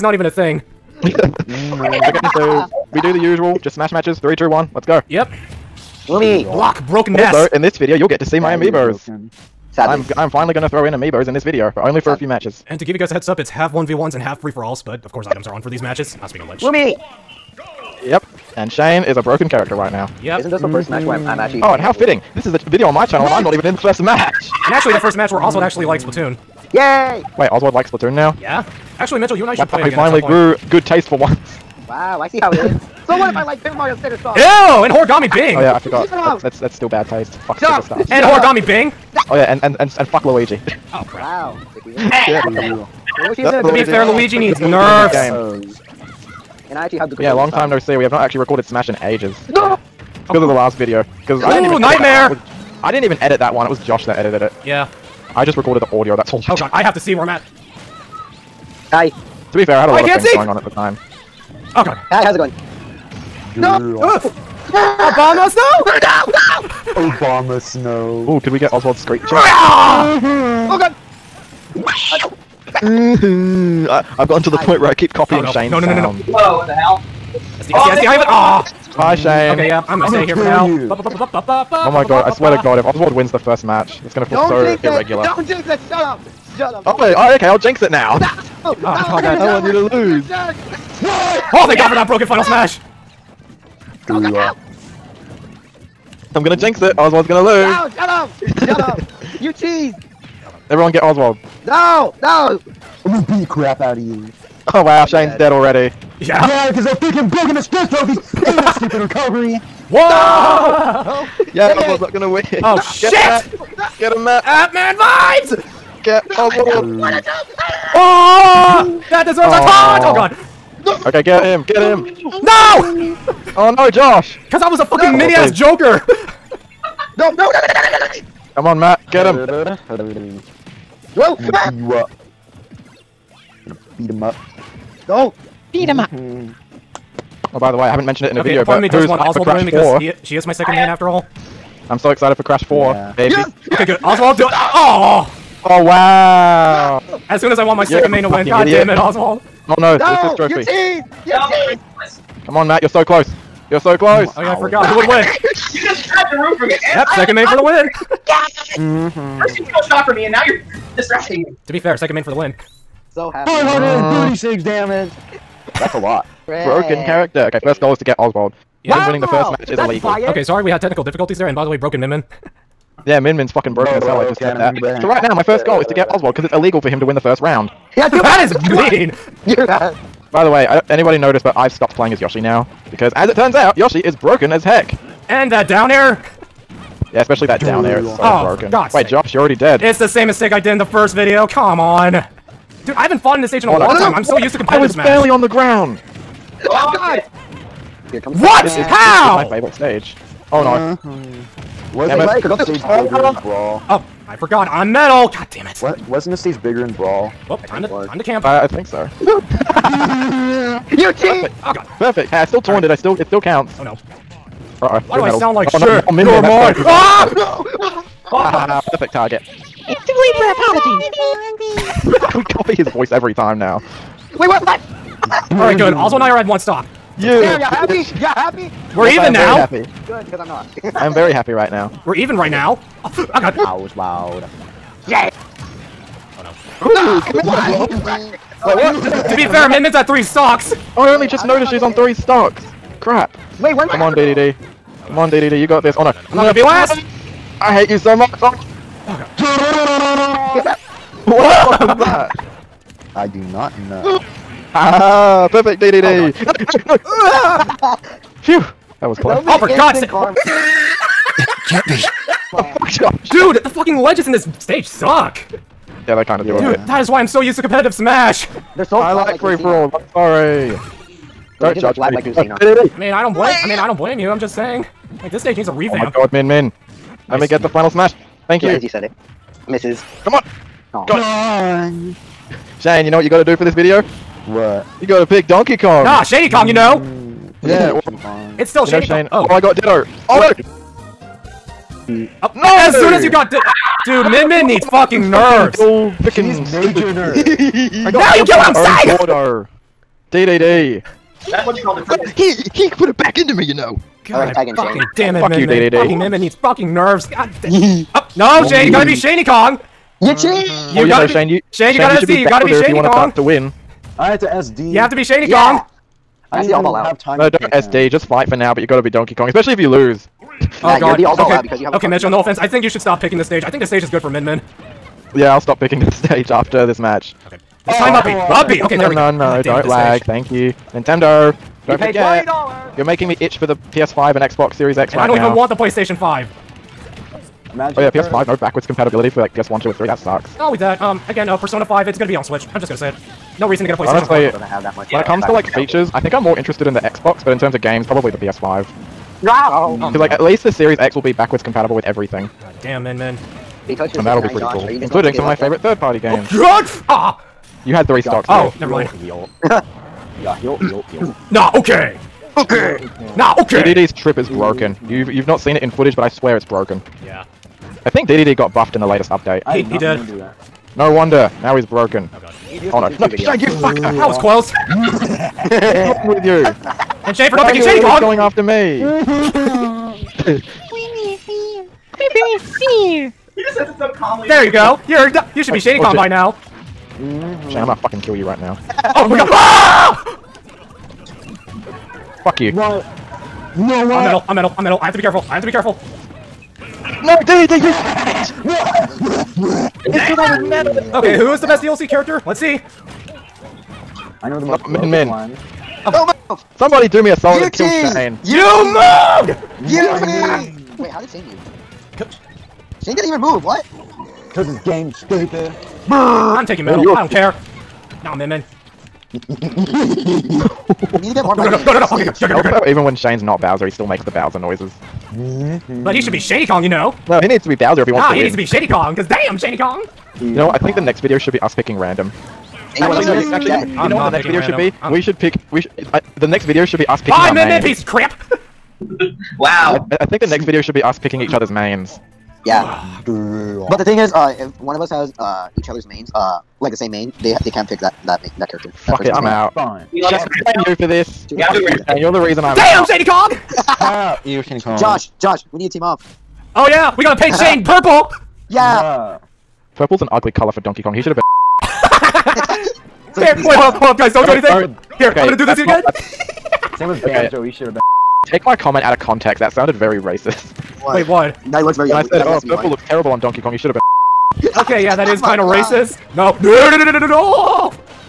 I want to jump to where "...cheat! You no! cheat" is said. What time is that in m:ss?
2:30.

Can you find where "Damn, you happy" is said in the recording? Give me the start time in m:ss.
3:47.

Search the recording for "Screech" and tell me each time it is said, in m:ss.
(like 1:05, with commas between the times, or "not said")
1:08.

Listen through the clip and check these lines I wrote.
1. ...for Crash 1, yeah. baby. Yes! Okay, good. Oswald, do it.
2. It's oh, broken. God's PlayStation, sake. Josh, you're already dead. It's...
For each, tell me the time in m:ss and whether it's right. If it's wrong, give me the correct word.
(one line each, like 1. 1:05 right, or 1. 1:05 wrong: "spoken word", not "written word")
1. 2:22 wrong: "4", not "1"
2. 3:07 wrong: "Wait", not "PlayStation".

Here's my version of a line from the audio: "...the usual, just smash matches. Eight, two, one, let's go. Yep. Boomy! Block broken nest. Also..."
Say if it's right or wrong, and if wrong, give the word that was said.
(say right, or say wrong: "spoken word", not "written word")
wrong: "Three", not "Eight".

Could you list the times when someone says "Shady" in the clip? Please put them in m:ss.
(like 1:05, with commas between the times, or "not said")
4:48, 6:25.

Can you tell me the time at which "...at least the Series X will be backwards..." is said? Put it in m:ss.
5:50.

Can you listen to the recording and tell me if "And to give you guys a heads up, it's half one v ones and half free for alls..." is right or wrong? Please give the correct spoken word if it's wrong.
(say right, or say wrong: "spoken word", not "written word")
right.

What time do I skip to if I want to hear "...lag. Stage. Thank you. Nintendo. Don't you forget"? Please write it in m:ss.
5:29.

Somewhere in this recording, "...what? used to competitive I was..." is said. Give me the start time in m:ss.
3:14.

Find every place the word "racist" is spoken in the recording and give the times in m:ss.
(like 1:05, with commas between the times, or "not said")
7:50, 7:55.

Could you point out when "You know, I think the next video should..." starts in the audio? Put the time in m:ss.
7:10.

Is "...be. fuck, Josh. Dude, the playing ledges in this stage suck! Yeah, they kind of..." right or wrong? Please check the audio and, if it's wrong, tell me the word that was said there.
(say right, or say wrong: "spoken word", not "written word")
wrong: "fucking", not "playing".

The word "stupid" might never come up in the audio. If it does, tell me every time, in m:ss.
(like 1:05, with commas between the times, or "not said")
1:48, 6:55.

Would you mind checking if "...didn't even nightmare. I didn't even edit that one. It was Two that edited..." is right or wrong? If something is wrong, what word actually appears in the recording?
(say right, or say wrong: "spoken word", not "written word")
wrong: "Josh", not "Two".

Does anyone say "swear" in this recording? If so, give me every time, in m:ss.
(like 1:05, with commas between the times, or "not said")
1:22, 6:06.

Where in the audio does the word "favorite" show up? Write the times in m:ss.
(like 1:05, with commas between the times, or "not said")
3:19, 5:55.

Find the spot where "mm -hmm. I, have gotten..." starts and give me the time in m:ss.
1:12.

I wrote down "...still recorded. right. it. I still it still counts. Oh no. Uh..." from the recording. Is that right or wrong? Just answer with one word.
wrong.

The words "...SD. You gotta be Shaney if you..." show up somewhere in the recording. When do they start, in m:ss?
5:12.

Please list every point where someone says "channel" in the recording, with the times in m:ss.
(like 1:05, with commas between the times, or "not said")
0:23.